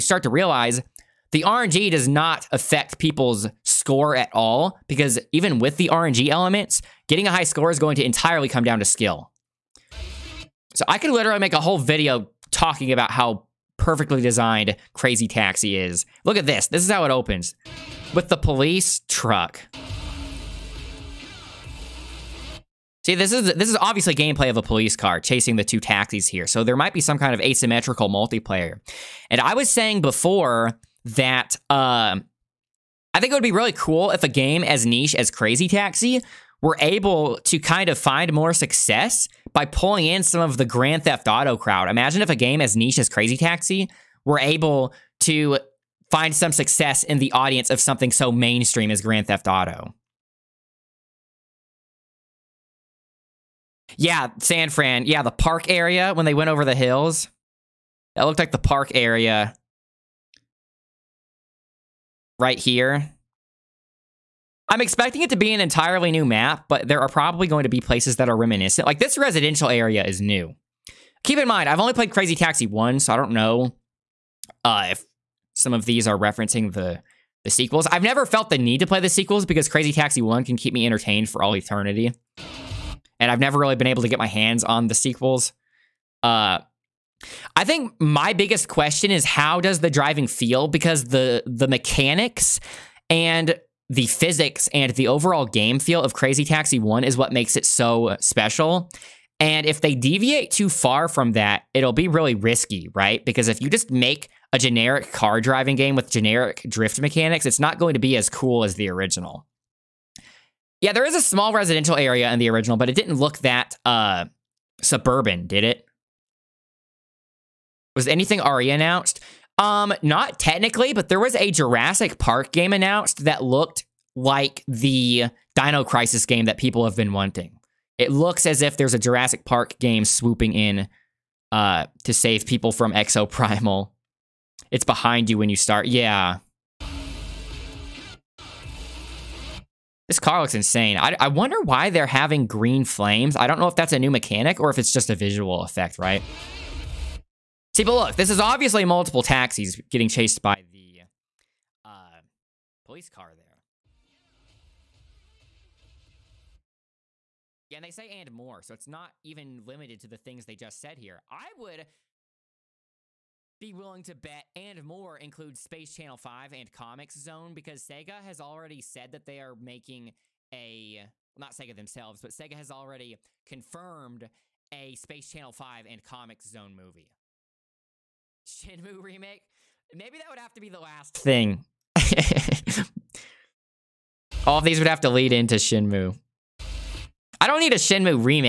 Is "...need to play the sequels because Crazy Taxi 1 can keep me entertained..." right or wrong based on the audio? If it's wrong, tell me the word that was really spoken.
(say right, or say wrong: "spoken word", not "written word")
right.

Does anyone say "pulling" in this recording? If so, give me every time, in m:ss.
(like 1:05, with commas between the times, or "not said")
0:39.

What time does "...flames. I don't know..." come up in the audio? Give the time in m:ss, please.
2:22.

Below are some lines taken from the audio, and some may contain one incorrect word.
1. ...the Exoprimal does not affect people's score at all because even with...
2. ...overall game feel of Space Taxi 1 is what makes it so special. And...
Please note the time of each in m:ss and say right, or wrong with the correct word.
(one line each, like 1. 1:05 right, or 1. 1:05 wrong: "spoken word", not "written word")
1. 0:01 wrong: "RNG", not "Exoprimal"
2. 1:35 wrong: "Crazy", not "Space".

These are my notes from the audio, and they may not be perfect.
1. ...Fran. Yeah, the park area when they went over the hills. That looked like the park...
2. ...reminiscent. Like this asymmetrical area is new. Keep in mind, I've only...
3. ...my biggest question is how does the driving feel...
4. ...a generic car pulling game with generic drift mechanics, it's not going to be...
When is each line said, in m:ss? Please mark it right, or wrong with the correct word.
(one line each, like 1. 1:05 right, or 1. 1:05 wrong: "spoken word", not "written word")
1. 0:54 right
2. 1:08 wrong: "residential", not "asymmetrical"
3. 1:27 right
4. 1:44 wrong: "driving", not "pulling".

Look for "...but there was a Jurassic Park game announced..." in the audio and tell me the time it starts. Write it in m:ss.
2:00.